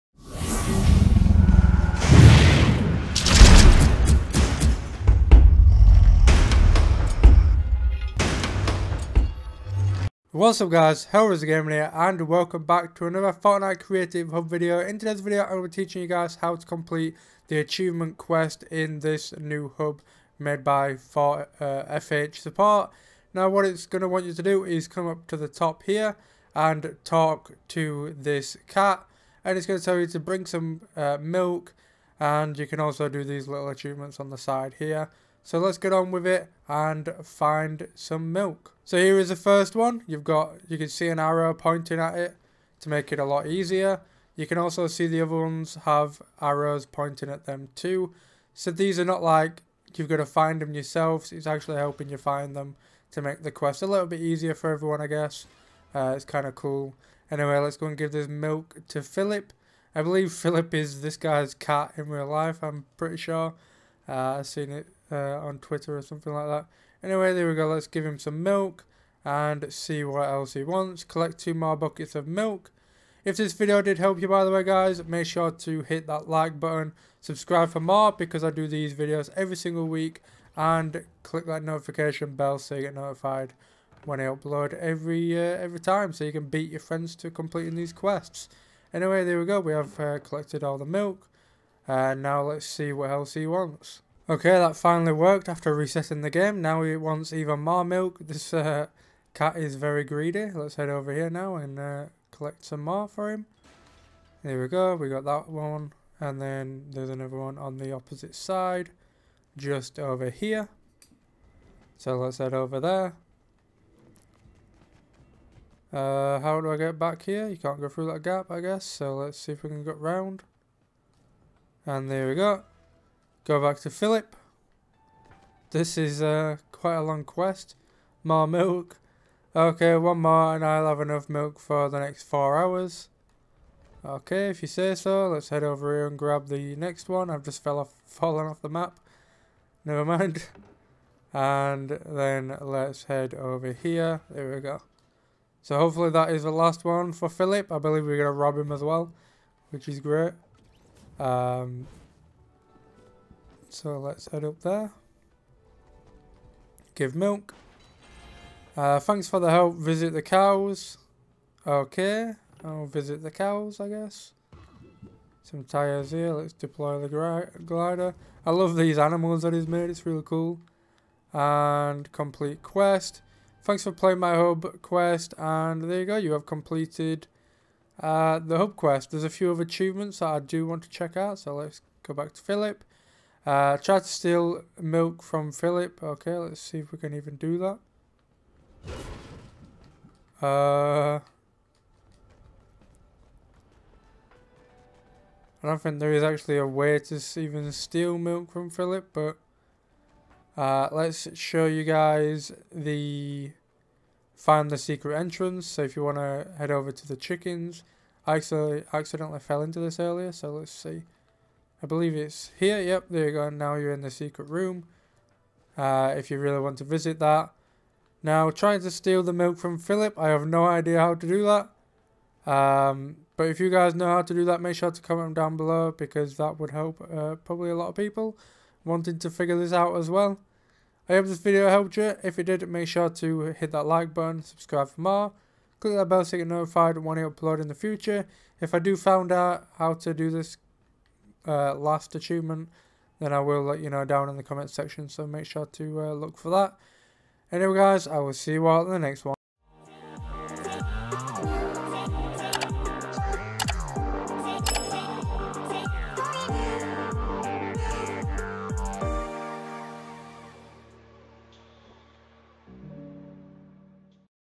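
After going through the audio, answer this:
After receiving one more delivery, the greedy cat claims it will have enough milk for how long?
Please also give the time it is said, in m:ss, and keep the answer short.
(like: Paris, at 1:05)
4 hours, at 2:12.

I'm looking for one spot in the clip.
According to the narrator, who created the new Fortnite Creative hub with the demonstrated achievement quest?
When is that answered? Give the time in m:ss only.
0:21.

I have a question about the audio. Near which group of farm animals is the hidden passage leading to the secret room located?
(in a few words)
The chickens.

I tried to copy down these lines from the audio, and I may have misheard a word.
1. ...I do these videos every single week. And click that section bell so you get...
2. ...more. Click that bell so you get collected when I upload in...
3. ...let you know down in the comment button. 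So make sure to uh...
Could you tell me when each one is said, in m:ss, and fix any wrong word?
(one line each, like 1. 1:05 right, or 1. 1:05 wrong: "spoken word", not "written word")
1. 1:18 wrong: "notification", not "section"
2. 3:55 wrong: "notified", not "collected"
3. 4:03 wrong: "section", not "button".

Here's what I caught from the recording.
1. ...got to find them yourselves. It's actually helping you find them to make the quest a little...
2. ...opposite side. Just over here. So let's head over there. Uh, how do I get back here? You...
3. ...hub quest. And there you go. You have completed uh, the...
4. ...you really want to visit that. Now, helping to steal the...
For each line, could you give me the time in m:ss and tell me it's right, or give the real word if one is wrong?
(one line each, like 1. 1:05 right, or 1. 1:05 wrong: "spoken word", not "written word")
1. 0:50 right
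2. 1:47 right
3. 2:54 right
4. 3:36 wrong: "trying", not "helping".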